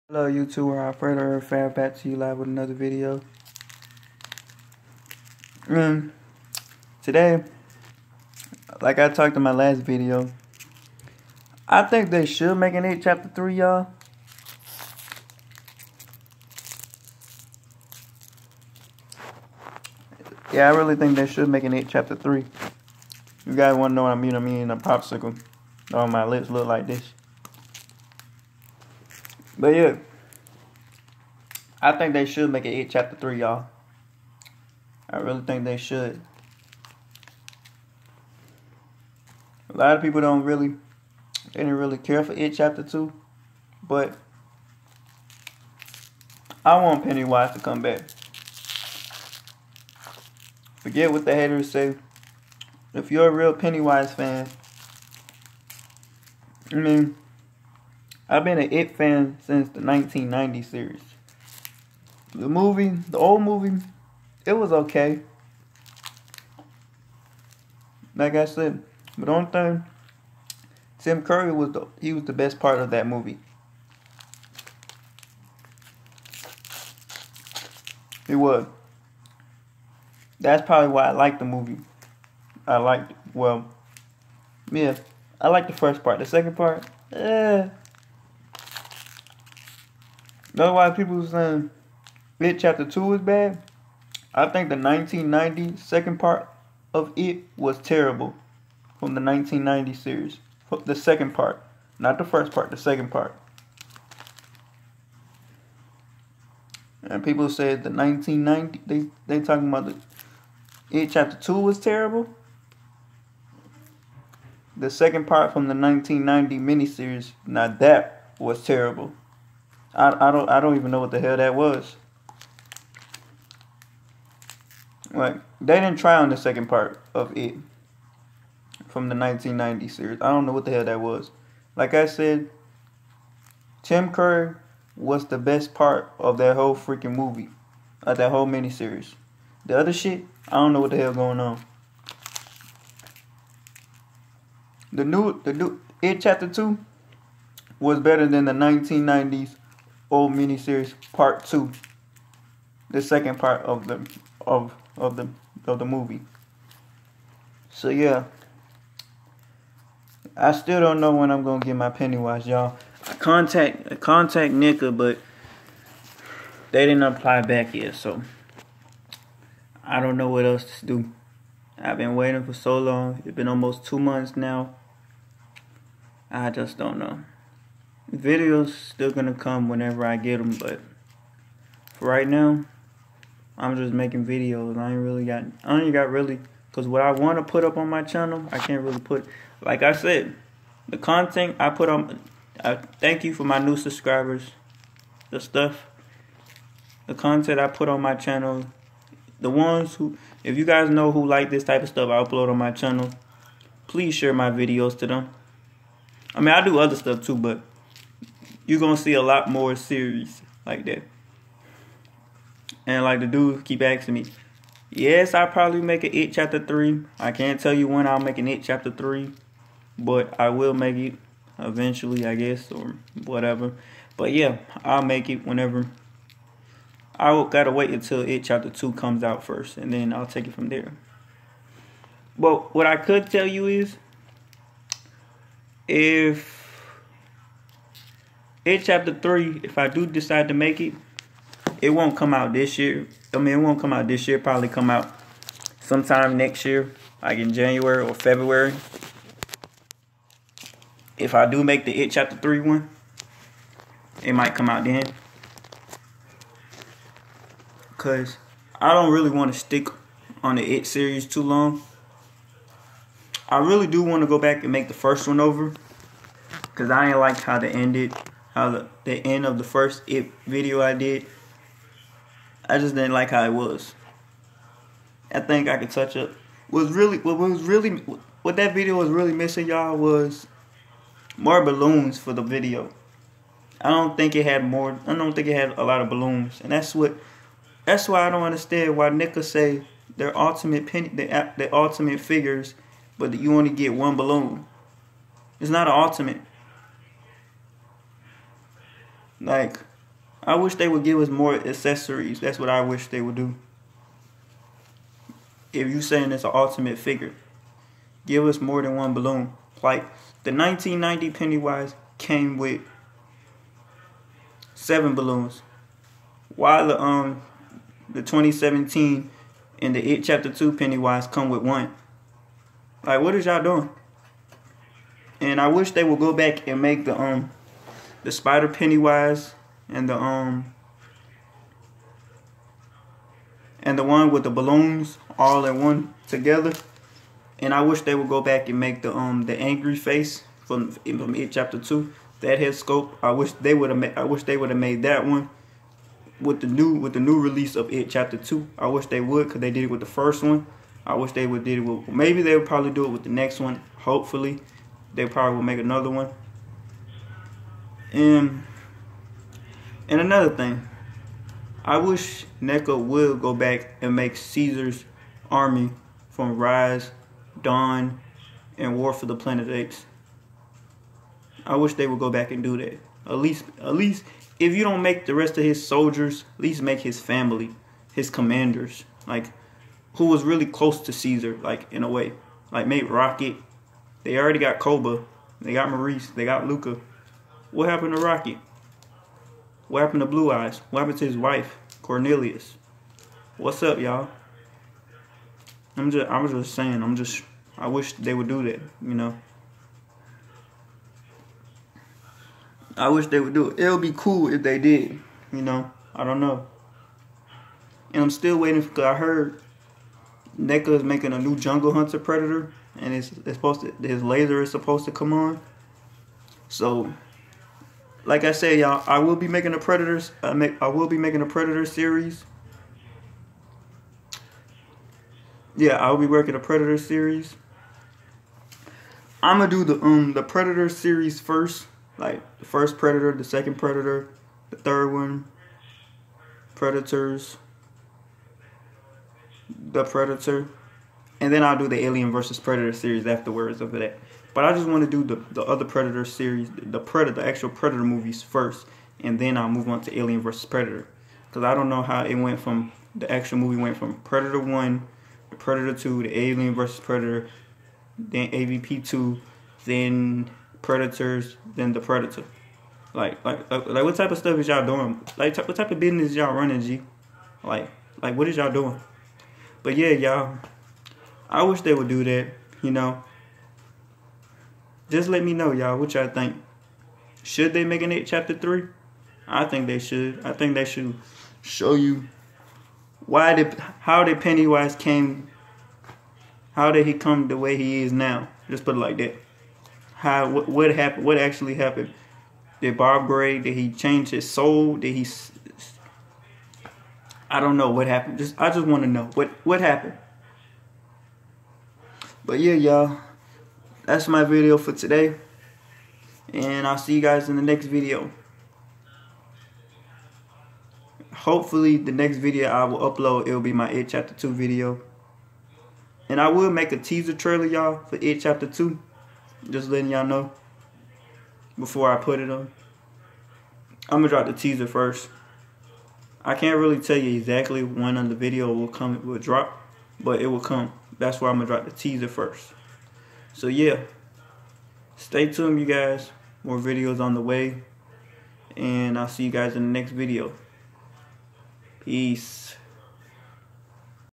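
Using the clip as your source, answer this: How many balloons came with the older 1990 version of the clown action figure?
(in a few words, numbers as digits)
7.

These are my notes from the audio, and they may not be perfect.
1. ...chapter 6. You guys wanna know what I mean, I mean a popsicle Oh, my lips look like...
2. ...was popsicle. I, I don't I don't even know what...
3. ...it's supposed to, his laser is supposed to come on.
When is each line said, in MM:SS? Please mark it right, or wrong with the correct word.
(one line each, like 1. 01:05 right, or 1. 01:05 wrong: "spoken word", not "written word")
1. 00:21 wrong: "3", not "6"
2. 01:58 wrong: "terrible", not "popsicle"
3. 06:53 right.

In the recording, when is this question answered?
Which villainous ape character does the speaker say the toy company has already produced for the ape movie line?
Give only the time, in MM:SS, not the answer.
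06:24.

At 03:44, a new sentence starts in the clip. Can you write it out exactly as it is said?
But yeah, I'll make it whenever.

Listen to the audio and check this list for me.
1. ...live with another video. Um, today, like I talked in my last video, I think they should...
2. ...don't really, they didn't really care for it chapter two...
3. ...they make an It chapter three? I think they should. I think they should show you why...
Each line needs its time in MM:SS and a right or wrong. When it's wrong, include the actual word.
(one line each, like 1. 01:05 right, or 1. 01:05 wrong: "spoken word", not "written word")
1. 00:02 right
2. 00:40 right
3. 07:57 right.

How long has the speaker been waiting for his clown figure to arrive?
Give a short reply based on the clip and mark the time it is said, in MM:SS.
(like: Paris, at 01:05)
almost two months, at 02:53.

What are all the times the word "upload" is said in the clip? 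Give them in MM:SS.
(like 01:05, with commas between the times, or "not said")
03:22, 08:32.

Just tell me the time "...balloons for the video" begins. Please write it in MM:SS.
04:41.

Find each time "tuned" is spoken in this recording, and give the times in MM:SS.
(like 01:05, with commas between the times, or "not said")
08:55.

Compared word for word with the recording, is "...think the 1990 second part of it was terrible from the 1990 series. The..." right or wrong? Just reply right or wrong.
right.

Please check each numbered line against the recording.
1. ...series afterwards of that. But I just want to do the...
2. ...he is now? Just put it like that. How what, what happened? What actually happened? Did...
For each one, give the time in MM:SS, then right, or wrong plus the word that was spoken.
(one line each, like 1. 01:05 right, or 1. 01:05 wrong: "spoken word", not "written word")
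1. 07:22 right
2. 08:07 right.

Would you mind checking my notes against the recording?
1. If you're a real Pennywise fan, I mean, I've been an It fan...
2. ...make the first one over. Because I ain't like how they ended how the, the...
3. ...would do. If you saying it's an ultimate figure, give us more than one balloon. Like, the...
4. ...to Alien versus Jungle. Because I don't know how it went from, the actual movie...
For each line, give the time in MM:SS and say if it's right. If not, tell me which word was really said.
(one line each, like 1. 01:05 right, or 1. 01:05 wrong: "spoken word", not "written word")
1. 00:52 right
2. 04:24 right
3. 05:03 right
4. 07:30 wrong: "Predator", not "Jungle".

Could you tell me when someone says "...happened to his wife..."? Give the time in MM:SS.
06:31.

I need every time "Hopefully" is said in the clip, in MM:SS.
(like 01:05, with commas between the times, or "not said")
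05:53, 08:31.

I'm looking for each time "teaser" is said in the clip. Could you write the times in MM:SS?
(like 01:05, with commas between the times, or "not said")
08:36, 08:44, 08:51.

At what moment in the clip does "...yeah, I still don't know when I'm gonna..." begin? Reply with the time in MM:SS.
02:37.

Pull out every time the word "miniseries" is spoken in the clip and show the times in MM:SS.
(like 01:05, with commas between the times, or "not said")
01:56, 02:18, 02:30.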